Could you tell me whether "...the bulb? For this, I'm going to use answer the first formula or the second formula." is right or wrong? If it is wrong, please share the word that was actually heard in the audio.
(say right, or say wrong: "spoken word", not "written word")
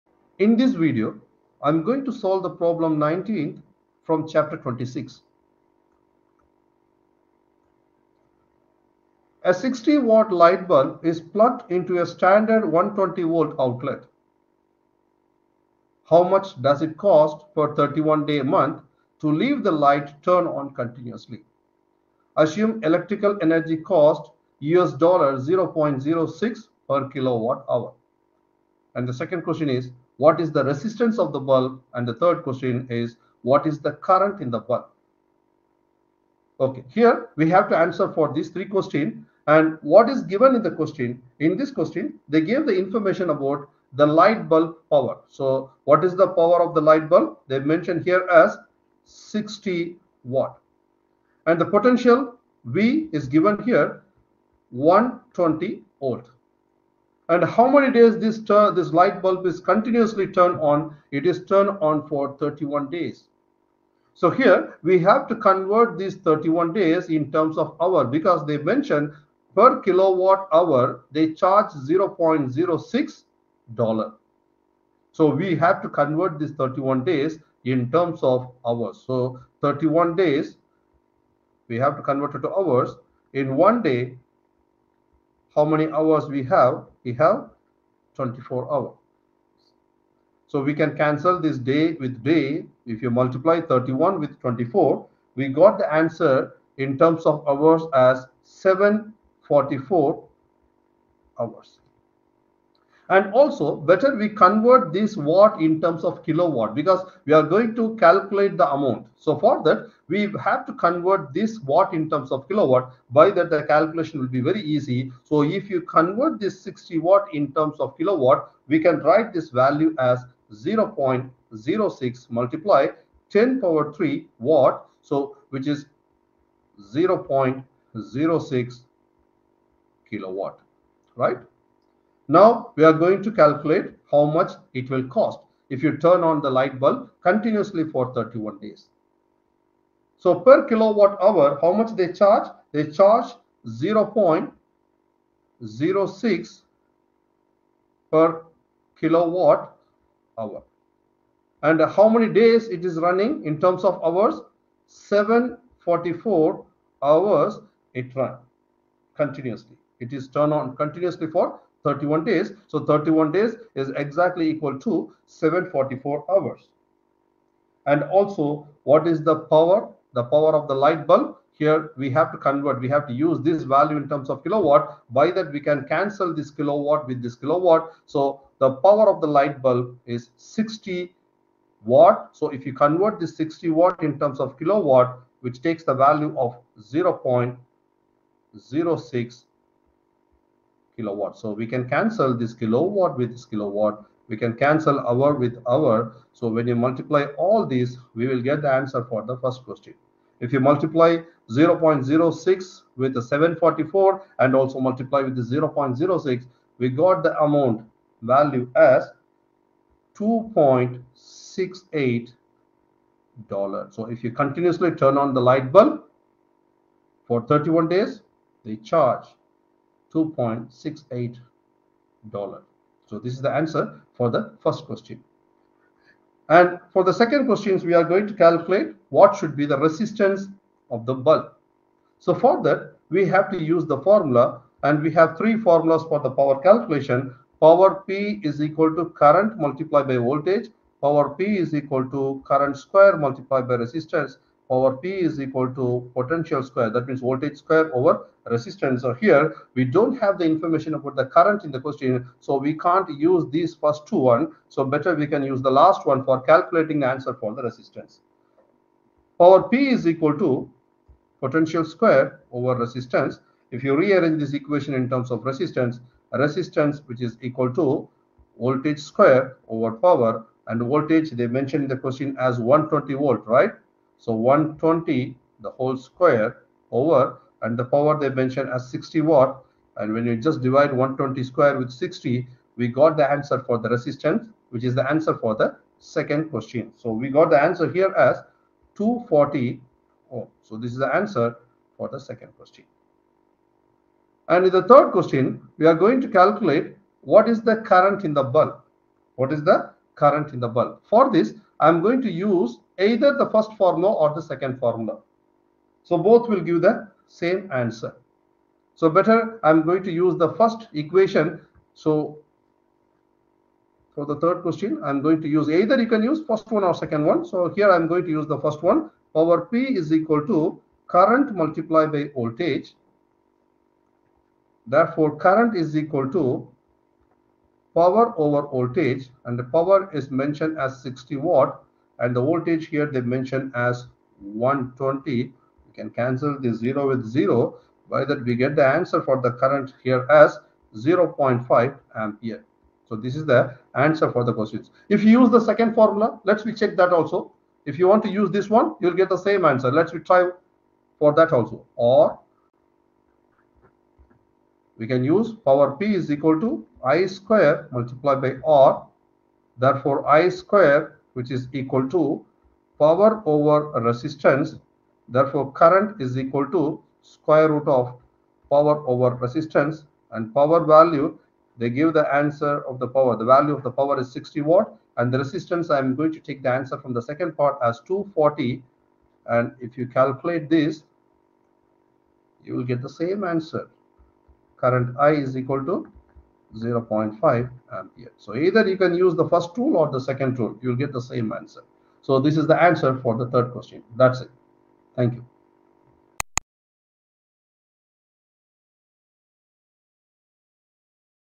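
wrong: "either", not "answer".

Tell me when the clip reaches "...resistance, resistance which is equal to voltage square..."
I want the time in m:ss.
4:25.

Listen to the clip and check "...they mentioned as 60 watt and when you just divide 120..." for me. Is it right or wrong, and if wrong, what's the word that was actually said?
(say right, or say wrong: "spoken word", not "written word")
right.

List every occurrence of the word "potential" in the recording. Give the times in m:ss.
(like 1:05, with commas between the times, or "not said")
0:51, 4:06, 4:21.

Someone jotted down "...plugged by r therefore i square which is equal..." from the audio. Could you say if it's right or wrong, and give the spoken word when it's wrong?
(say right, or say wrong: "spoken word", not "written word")
wrong: "multiplied", not "plugged".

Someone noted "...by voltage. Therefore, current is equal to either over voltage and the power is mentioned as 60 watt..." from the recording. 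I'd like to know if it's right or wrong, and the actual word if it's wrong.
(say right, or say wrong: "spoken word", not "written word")
wrong: "power", not "either".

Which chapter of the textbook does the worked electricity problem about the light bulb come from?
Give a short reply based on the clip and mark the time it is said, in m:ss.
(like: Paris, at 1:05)
26, at 0:04.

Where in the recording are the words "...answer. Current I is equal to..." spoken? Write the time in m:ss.
6:23.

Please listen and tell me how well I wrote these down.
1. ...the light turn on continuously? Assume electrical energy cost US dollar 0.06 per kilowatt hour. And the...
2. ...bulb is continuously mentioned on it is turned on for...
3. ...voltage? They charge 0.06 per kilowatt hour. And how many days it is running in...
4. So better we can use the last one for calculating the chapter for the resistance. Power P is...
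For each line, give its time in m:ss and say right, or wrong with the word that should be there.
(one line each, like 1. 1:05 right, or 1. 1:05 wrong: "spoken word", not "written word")
1. 0:19 right
2. 0:59 wrong: "turned", not "mentioned"
3. 2:22 wrong: "charge", not "voltage"
4. 4:14 wrong: "answer", not "chapter".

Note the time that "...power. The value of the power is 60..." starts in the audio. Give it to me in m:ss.
6:13.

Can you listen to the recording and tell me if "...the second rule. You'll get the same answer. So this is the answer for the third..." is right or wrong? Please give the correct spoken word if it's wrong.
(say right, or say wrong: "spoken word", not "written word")
right.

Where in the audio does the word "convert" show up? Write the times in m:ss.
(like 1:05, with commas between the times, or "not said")
1:05, 1:15, 1:22, 1:44, 1:50, 1:55, 2:52, 3:02.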